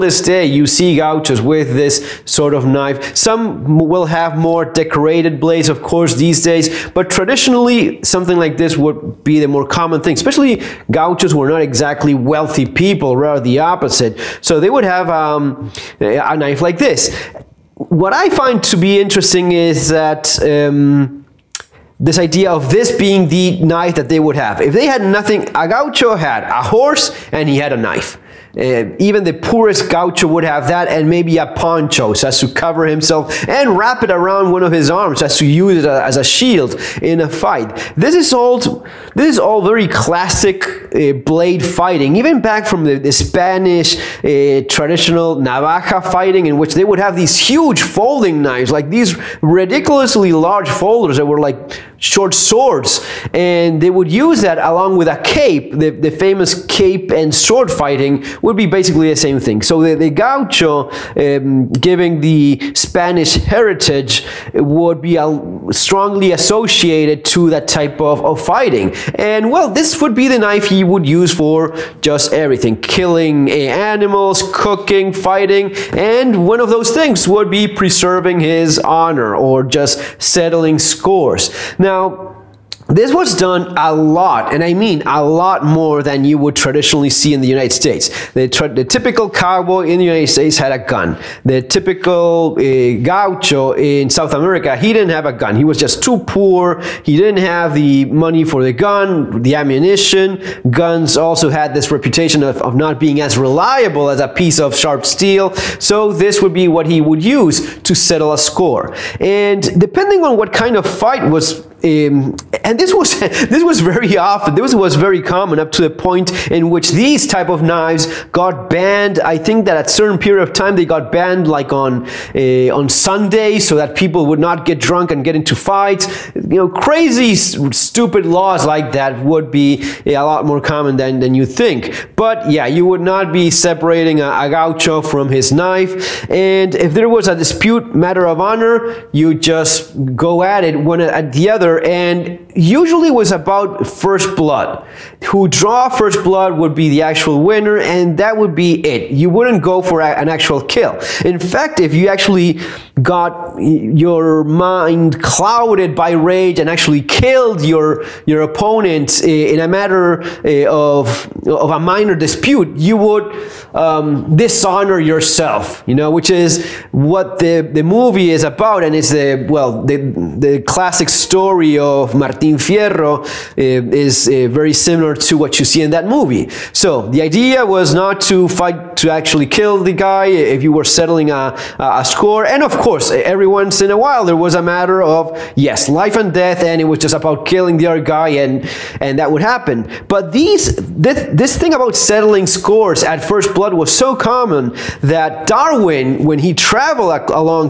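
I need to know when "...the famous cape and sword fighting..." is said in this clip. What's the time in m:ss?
0:55.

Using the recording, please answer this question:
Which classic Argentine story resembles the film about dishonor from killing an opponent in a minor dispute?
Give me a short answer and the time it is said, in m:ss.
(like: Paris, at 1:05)
Martin Fierro, at 2:52.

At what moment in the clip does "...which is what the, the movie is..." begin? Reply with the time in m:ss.
2:46.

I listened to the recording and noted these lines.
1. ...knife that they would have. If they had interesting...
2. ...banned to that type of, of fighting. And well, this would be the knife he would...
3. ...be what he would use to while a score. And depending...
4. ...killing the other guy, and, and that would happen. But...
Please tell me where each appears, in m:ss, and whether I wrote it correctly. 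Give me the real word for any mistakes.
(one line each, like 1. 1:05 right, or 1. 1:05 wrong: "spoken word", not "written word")
1. 0:23 wrong: "nothing", not "interesting"
2. 1:06 wrong: "associated", not "banned"
3. 1:46 wrong: "settle", not "while"
4. 3:07 right.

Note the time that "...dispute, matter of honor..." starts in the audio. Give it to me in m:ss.
2:17.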